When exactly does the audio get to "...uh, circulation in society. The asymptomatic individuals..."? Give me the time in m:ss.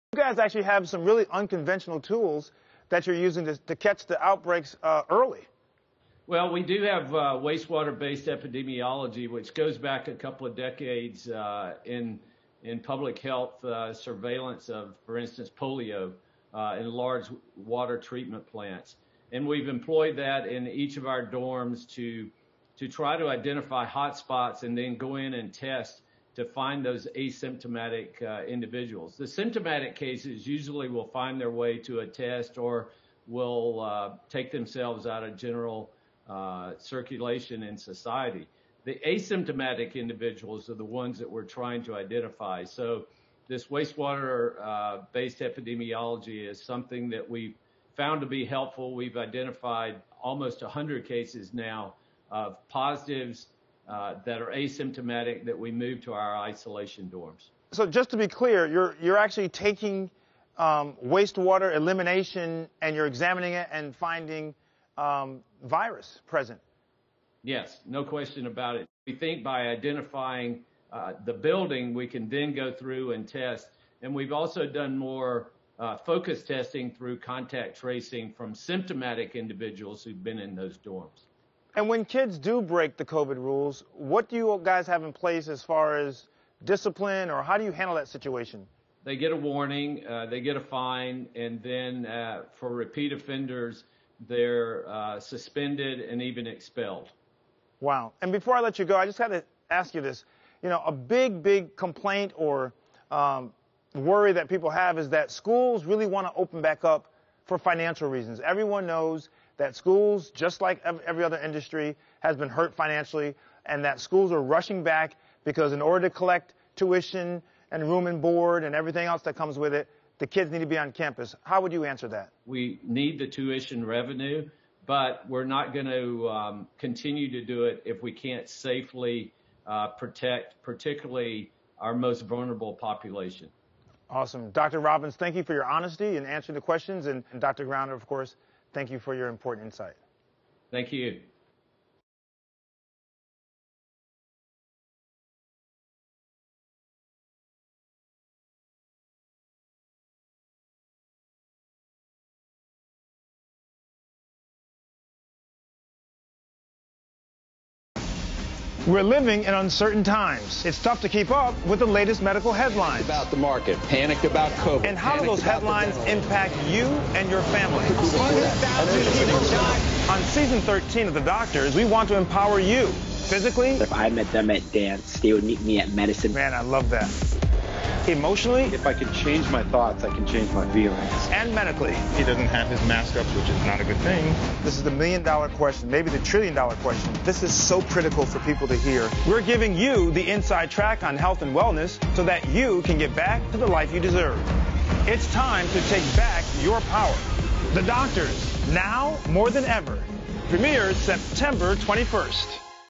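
0:36.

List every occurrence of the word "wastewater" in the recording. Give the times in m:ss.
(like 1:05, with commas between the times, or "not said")
0:07, 0:43, 1:01.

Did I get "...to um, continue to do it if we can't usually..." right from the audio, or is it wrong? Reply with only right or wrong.
wrong.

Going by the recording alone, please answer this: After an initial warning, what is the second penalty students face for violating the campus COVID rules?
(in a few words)
a fine.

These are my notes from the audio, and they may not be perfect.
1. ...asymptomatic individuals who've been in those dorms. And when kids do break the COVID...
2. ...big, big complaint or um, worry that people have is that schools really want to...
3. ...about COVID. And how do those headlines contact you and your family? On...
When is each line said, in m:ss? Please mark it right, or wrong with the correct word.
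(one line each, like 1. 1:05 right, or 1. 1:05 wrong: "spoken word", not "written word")
1. 1:18 wrong: "symptomatic", not "asymptomatic"
2. 1:40 right
3. 2:44 wrong: "impact", not "contact".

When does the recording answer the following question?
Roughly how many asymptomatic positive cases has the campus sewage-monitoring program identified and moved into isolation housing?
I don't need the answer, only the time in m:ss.
0:50.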